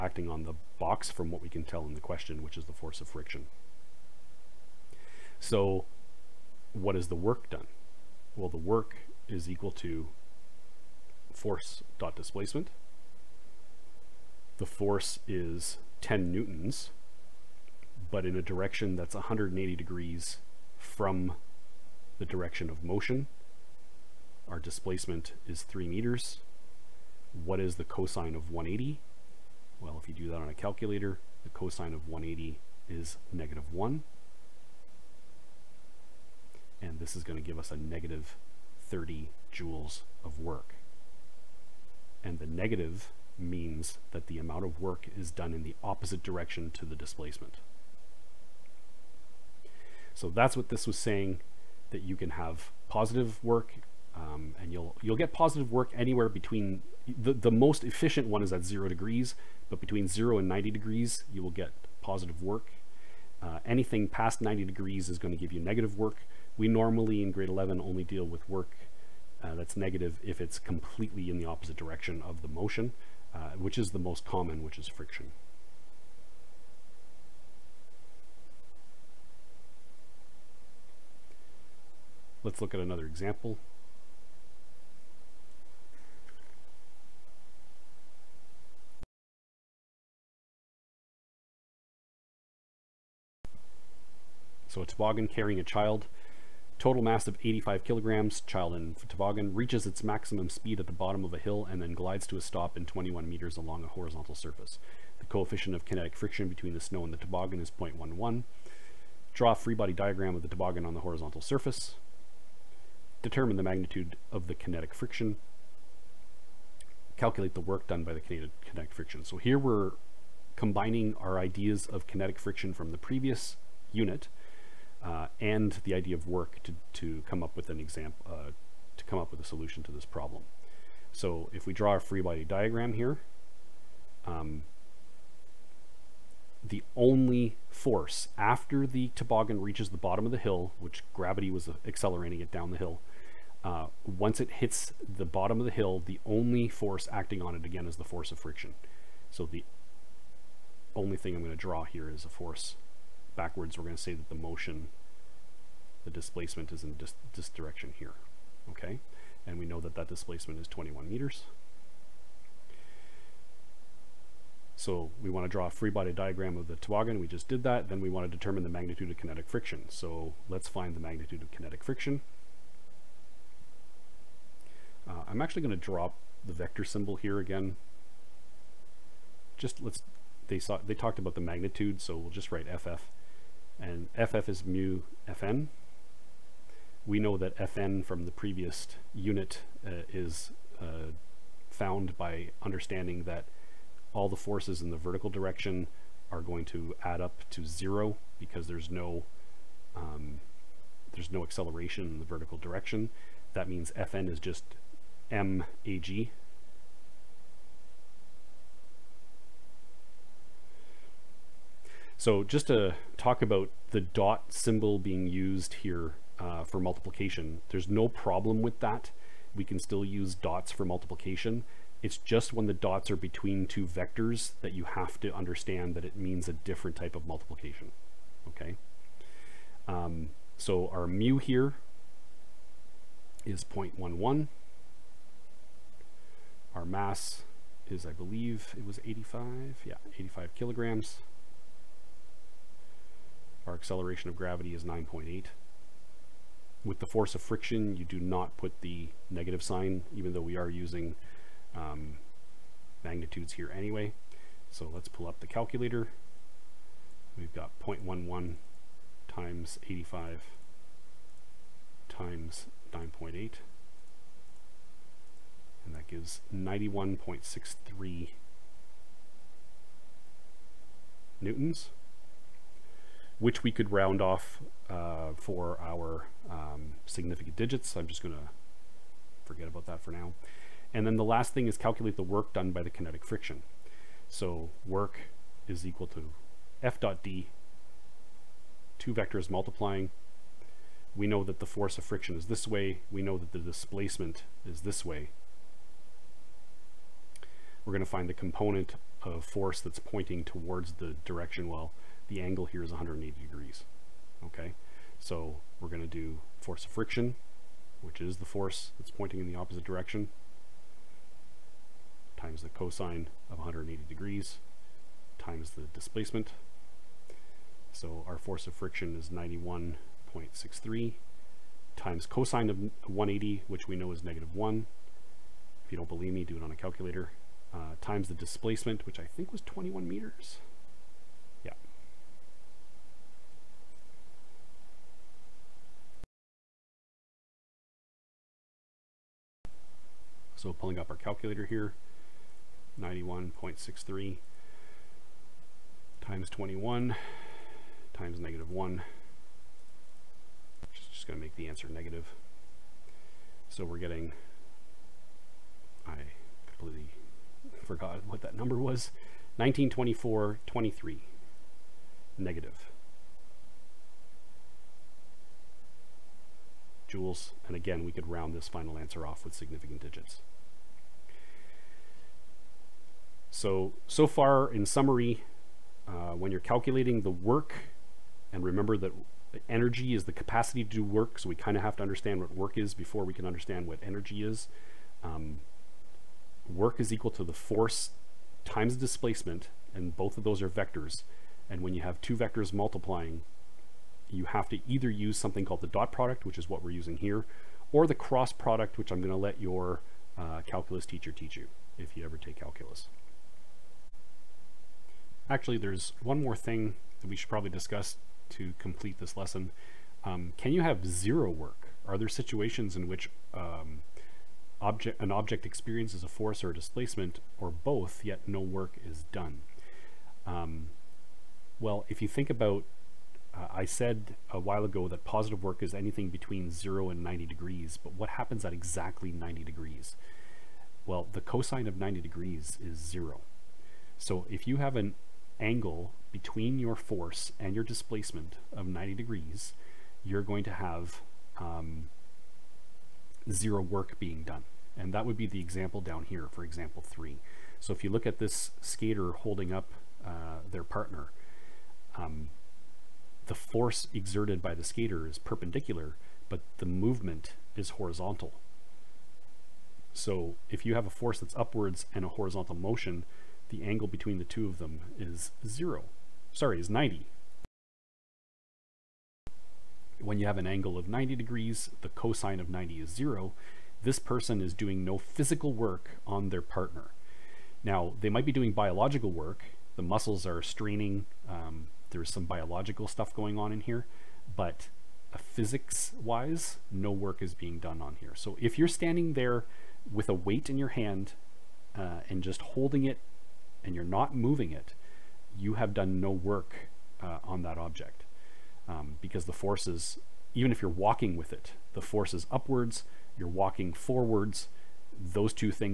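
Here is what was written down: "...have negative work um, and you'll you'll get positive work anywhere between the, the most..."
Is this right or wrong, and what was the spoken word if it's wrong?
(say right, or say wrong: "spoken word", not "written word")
wrong: "positive", not "negative".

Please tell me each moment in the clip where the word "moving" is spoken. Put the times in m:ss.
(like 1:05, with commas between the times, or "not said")
8:14.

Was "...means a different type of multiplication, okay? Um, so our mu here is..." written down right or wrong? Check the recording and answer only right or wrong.
right.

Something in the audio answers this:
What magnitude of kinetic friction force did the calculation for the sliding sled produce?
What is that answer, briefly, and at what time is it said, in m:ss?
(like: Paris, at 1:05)
91.63 newtons, at 4:26.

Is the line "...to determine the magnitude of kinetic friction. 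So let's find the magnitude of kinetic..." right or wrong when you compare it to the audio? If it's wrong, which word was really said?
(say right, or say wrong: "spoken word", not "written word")
right.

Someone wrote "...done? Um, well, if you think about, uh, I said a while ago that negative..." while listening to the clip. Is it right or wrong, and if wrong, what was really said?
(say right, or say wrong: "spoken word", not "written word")
wrong: "positive", not "negative".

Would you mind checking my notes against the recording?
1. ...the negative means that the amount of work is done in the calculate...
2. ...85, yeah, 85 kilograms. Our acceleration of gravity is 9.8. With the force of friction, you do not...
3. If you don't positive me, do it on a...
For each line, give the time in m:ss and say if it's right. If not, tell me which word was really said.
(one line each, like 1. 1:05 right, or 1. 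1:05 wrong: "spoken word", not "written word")
1. 0:42 wrong: "opposite", not "calculate"
2. 3:59 right
3. 5:25 wrong: "believe", not "positive".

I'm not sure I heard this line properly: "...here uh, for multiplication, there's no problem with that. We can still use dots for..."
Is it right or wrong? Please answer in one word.
right.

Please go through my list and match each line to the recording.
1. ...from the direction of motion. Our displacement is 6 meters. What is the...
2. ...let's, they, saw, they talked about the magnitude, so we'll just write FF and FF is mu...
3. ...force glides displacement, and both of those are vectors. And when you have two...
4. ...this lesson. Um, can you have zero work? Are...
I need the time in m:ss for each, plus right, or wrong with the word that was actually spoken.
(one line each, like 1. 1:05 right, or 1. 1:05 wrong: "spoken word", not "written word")
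1. 0:20 wrong: "3", not "6"
2. 2:59 right
3. 6:27 wrong: "times", not "glides"
4. 6:49 right.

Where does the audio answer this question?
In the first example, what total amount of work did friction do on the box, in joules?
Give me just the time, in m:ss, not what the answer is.
0:37.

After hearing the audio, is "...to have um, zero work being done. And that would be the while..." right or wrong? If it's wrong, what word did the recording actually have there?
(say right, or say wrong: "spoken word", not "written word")
wrong: "example", not "while".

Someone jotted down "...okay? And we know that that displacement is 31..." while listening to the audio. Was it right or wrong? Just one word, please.
wrong.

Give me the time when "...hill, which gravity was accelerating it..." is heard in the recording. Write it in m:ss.
2:20.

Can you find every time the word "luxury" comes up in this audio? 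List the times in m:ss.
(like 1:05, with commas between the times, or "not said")
not said.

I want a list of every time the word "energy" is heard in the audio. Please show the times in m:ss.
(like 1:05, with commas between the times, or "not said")
6:19, 6:24.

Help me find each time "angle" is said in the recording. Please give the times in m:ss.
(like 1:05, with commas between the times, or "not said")
5:02, 7:15, 7:43, 7:50.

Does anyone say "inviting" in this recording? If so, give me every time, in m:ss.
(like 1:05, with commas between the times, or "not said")
not said.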